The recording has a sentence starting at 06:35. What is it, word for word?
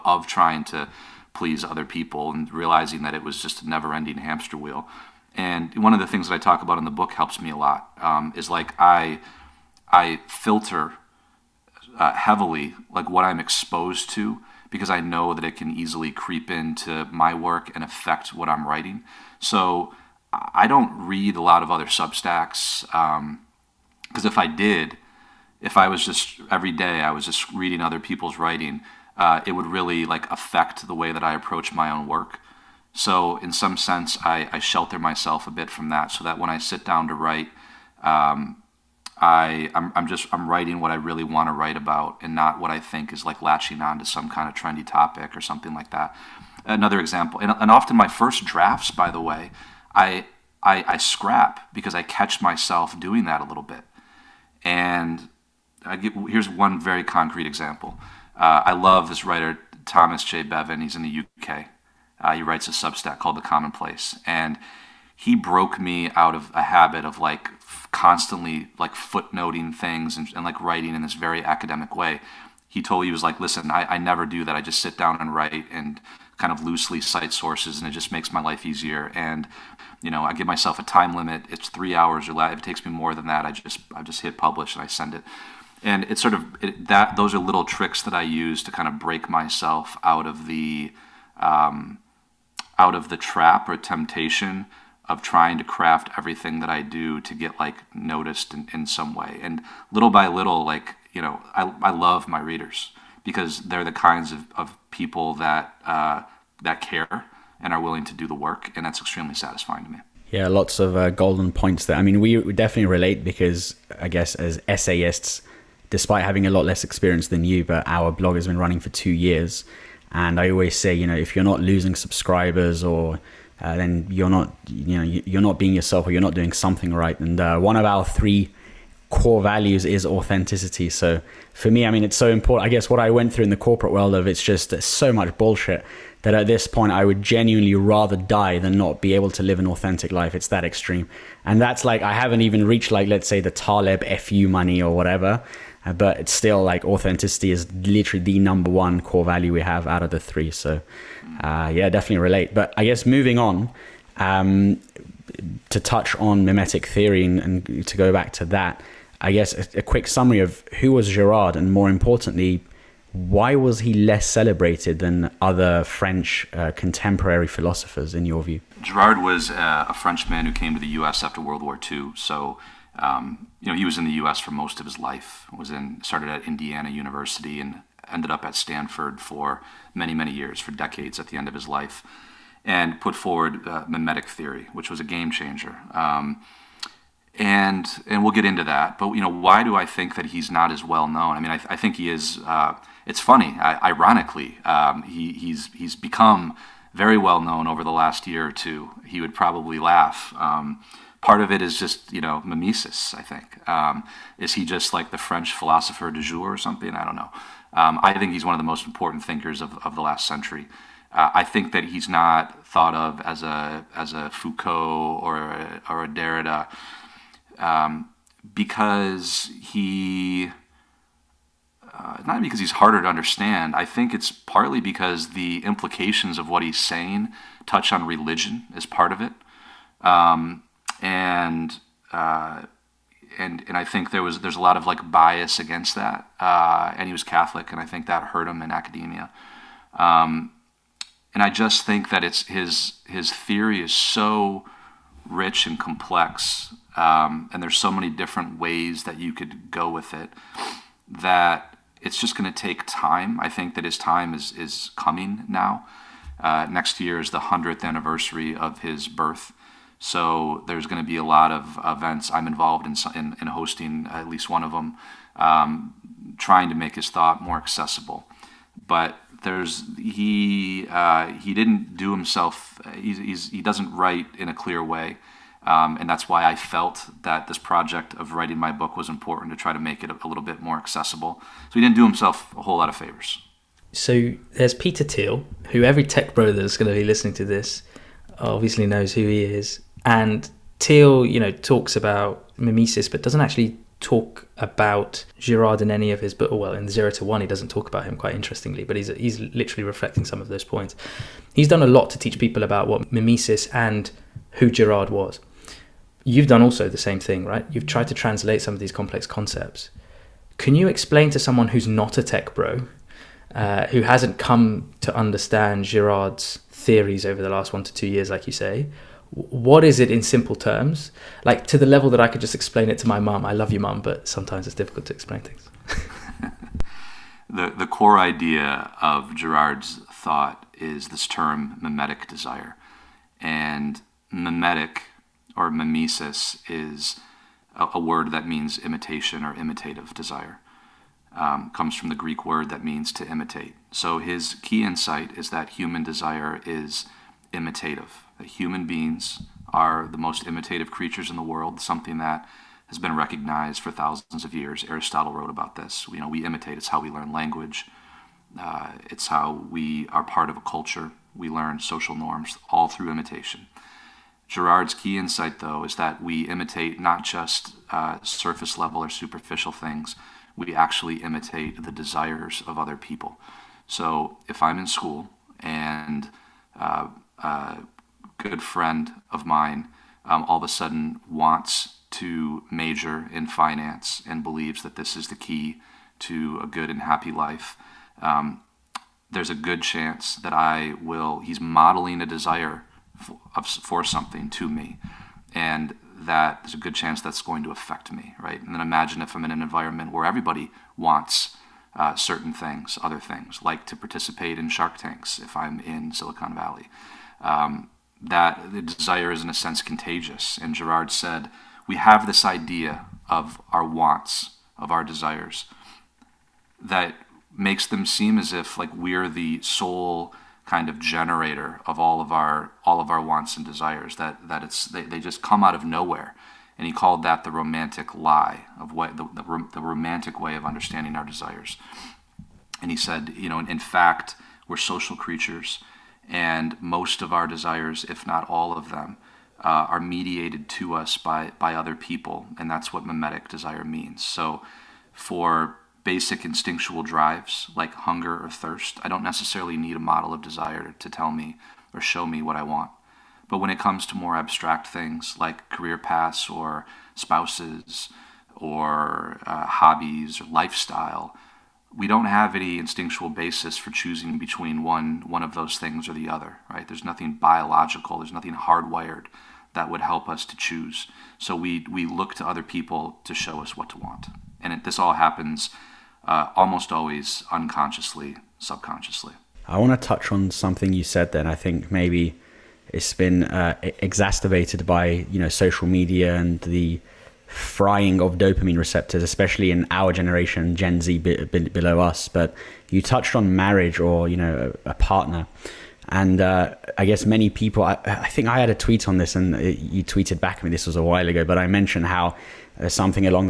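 And that there's a good chance that's going to affect me, right?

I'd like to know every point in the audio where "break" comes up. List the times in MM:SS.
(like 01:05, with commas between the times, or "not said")
01:28.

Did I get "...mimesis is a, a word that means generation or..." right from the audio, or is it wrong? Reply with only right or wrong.
wrong.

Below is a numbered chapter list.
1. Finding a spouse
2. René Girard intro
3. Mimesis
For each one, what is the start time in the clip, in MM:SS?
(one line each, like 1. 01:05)
1. 07:58
2. 02:34
3. 04:42.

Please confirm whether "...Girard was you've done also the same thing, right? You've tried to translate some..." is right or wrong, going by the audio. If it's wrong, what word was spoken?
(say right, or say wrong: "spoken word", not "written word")
right.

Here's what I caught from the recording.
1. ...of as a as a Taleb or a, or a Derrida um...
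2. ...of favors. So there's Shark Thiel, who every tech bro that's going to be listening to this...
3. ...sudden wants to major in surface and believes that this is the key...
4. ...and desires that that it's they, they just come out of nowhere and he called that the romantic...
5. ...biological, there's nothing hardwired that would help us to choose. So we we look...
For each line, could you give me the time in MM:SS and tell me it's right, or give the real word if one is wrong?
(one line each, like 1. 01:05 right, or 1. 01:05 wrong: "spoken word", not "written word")
1. 03:32 wrong: "Foucault", not "Taleb"
2. 04:42 wrong: "Peter", not "Shark"
3. 06:20 wrong: "finance", not "surface"
4. 07:03 right
5. 07:47 right.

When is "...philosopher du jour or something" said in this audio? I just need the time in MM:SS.
03:25.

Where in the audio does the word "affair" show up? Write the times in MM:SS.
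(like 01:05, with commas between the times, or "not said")
not said.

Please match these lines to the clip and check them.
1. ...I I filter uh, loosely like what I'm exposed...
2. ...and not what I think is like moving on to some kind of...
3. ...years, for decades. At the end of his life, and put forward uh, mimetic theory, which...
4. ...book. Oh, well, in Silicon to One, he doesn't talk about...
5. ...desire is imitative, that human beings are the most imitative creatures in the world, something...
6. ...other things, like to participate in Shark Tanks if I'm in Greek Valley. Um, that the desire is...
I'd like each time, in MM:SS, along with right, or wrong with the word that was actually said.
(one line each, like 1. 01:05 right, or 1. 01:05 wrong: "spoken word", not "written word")
1. 00:08 wrong: "heavily", not "loosely"
2. 00:42 wrong: "latching", not "moving"
3. 03:00 right
4. 04:56 wrong: "Zero", not "Silicon"
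5. 05:46 right
6. 06:43 wrong: "Silicon", not "Greek".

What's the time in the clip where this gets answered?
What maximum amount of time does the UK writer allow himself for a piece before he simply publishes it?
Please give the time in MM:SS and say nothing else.
01:21.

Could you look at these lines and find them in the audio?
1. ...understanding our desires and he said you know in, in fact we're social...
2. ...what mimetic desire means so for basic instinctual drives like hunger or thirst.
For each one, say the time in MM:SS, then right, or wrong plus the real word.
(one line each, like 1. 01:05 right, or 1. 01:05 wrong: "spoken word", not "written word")
1. 07:10 right
2. 07:22 right.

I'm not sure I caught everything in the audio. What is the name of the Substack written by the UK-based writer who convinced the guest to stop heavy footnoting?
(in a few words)
The Commonplace.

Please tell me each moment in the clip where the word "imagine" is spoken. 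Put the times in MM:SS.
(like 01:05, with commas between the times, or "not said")
06:38.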